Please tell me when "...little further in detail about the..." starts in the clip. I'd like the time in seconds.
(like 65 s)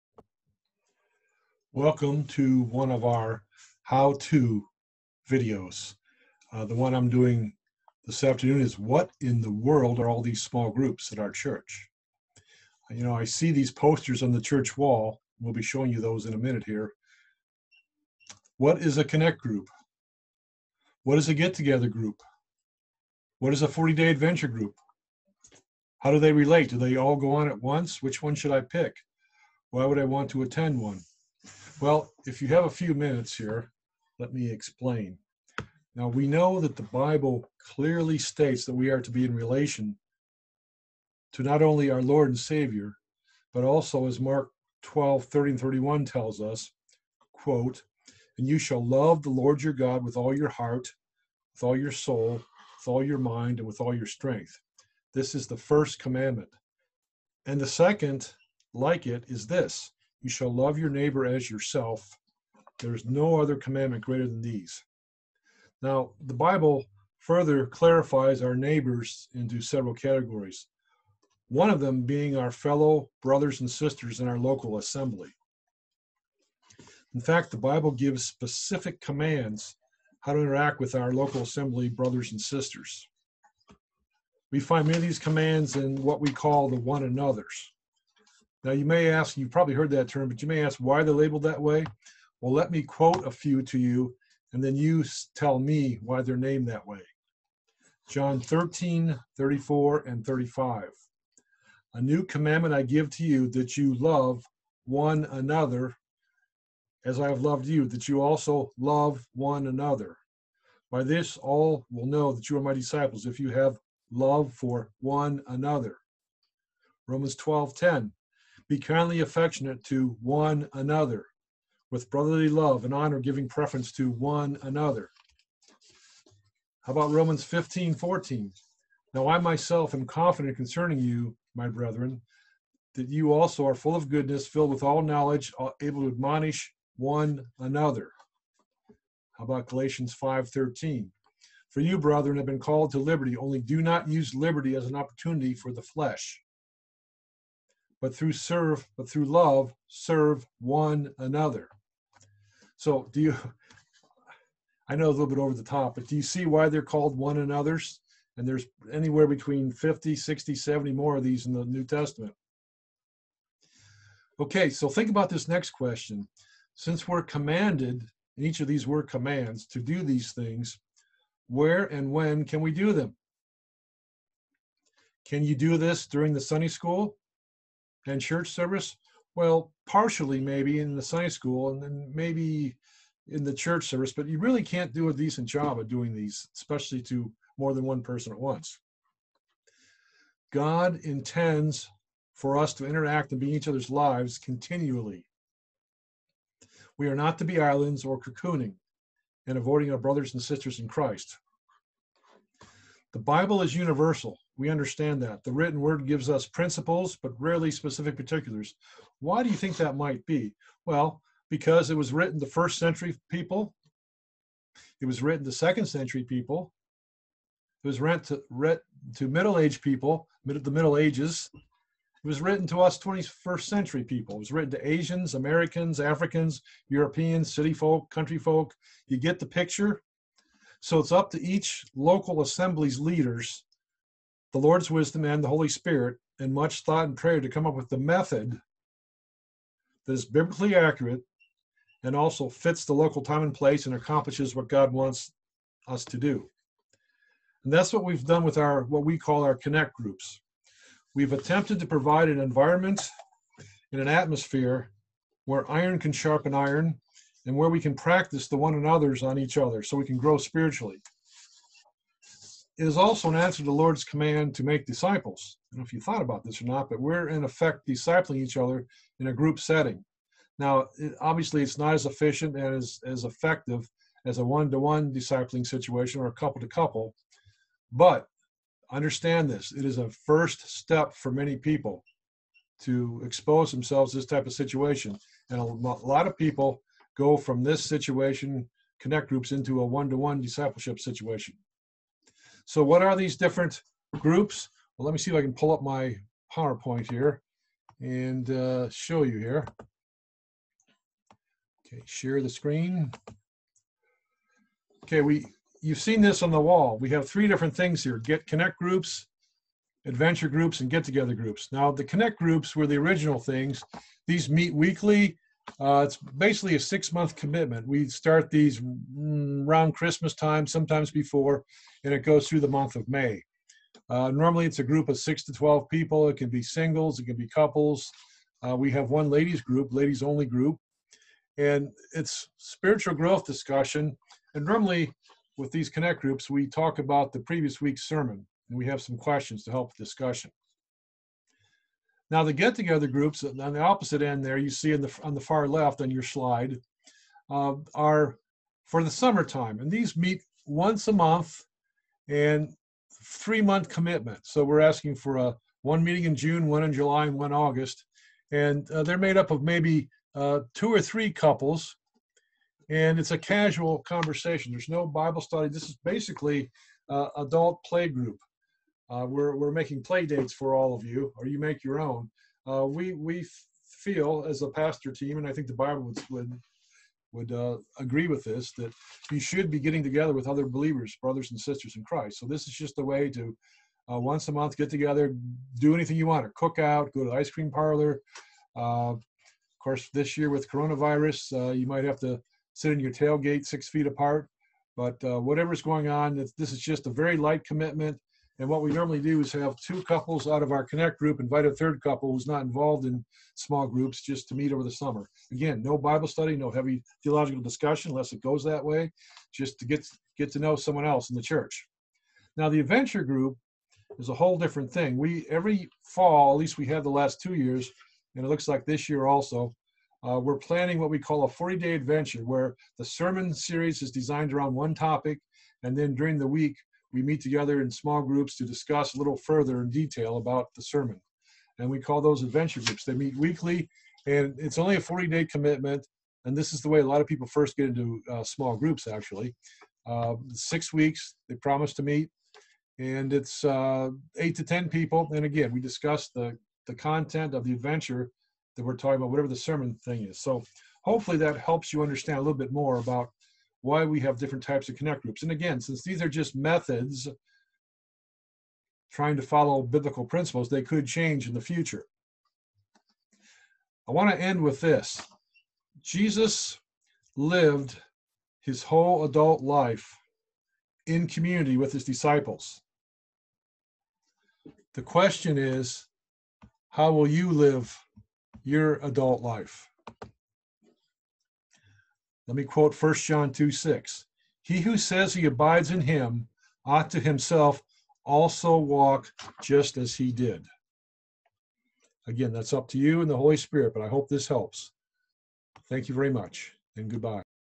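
429 s.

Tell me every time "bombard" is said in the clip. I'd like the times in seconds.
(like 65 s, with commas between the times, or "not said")
not said.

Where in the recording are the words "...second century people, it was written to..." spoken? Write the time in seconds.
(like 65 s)
215 s.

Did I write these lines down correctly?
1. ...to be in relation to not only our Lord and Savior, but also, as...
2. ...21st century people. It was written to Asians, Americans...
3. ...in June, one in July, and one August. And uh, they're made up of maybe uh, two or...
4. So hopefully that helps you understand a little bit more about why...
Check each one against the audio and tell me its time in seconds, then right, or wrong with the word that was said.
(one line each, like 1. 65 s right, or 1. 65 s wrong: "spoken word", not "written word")
1. 39 s right
2. 222 s right
3. 356 s right
4. 450 s right.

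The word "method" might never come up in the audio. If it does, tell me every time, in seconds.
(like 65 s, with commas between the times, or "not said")
237 s, 456 s.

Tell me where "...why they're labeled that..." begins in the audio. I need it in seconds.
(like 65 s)
90 s.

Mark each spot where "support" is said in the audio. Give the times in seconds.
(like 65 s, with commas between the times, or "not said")
not said.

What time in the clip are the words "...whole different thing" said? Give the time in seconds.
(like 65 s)
414 s.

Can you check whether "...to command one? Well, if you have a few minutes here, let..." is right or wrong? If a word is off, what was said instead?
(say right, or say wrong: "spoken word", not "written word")
wrong: "attend", not "command".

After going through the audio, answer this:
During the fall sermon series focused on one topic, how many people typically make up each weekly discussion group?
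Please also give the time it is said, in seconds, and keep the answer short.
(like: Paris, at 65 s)
8 to 10, at 444 s.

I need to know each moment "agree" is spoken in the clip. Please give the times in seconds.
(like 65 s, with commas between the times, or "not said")
377 s.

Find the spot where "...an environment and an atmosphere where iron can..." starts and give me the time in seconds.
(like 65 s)
252 s.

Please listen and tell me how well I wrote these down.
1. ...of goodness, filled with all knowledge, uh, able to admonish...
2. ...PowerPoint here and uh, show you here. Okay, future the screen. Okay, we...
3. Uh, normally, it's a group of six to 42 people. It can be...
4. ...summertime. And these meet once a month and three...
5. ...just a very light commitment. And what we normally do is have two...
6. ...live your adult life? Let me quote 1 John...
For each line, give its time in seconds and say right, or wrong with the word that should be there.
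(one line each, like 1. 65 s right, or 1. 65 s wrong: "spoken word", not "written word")
1. 133 s right
2. 296 s wrong: "share", not "future"
3. 324 s wrong: "12", not "42"
4. 349 s right
5. 396 s right
6. 477 s right.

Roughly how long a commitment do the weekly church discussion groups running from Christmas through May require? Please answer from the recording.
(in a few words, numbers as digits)
6 months.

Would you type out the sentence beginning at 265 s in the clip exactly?
I don't know if you thought about this or not, but we're in effect discipling each other in a group setting.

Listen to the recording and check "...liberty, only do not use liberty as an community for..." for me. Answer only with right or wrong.
wrong.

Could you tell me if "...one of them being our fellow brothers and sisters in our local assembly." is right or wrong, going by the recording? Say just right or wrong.
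right.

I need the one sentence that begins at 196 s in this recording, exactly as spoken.
We are not to be islands or cocooning and avoiding our brothers and sisters in Christ.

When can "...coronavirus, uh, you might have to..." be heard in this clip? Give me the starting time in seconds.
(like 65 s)
390 s.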